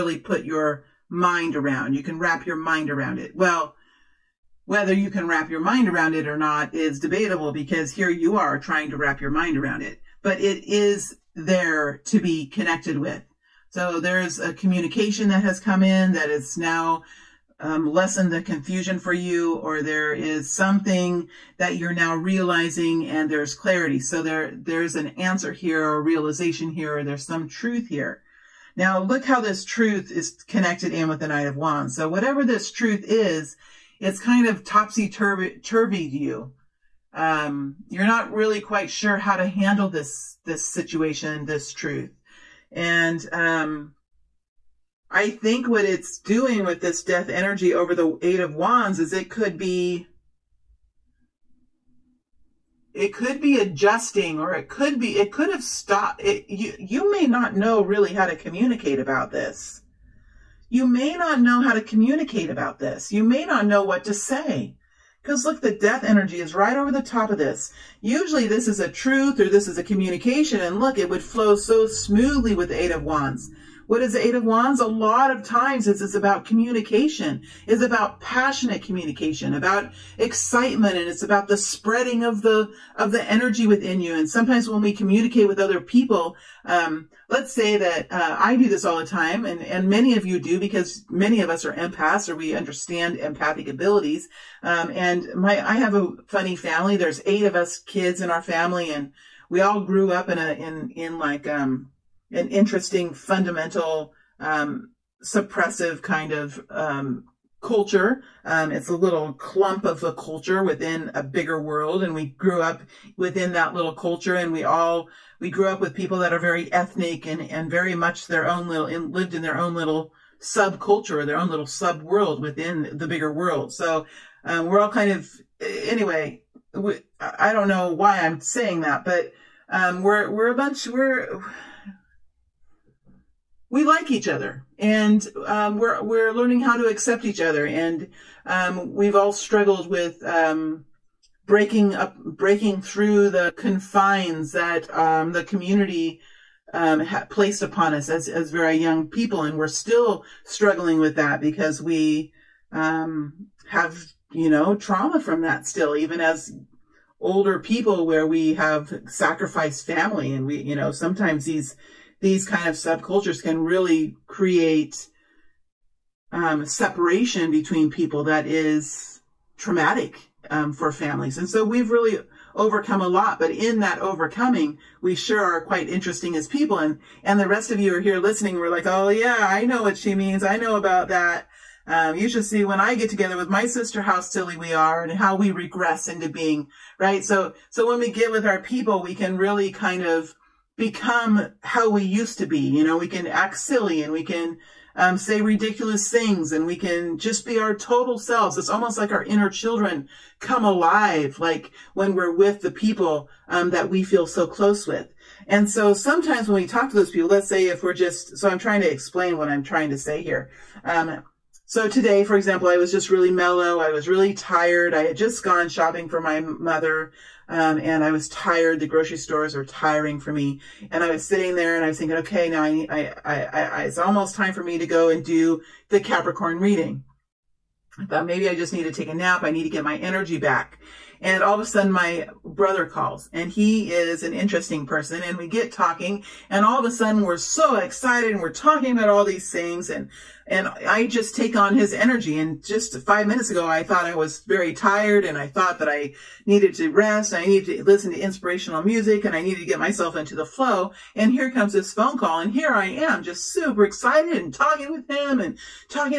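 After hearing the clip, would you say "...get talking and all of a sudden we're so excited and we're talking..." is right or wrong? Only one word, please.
right.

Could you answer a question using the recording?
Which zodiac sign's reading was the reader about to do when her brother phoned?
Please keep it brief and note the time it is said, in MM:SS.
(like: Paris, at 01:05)
Capricorn, at 03:45.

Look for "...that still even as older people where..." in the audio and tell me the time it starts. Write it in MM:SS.
02:35.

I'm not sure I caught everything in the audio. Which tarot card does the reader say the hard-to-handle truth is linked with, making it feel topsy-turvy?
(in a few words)
Knight of Wands.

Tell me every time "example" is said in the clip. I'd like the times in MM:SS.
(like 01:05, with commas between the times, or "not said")
03:32.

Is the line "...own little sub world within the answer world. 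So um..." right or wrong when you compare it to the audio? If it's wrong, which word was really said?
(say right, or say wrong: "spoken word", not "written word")
wrong: "bigger", not "answer".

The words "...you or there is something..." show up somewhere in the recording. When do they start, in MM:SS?
00:19.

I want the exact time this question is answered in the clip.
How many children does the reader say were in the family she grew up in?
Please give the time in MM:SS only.
01:37.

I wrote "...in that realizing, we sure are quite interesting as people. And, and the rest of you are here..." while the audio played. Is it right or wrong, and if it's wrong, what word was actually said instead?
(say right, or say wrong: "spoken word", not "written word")
wrong: "overcoming", not "realizing".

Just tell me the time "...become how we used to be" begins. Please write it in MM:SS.
03:10.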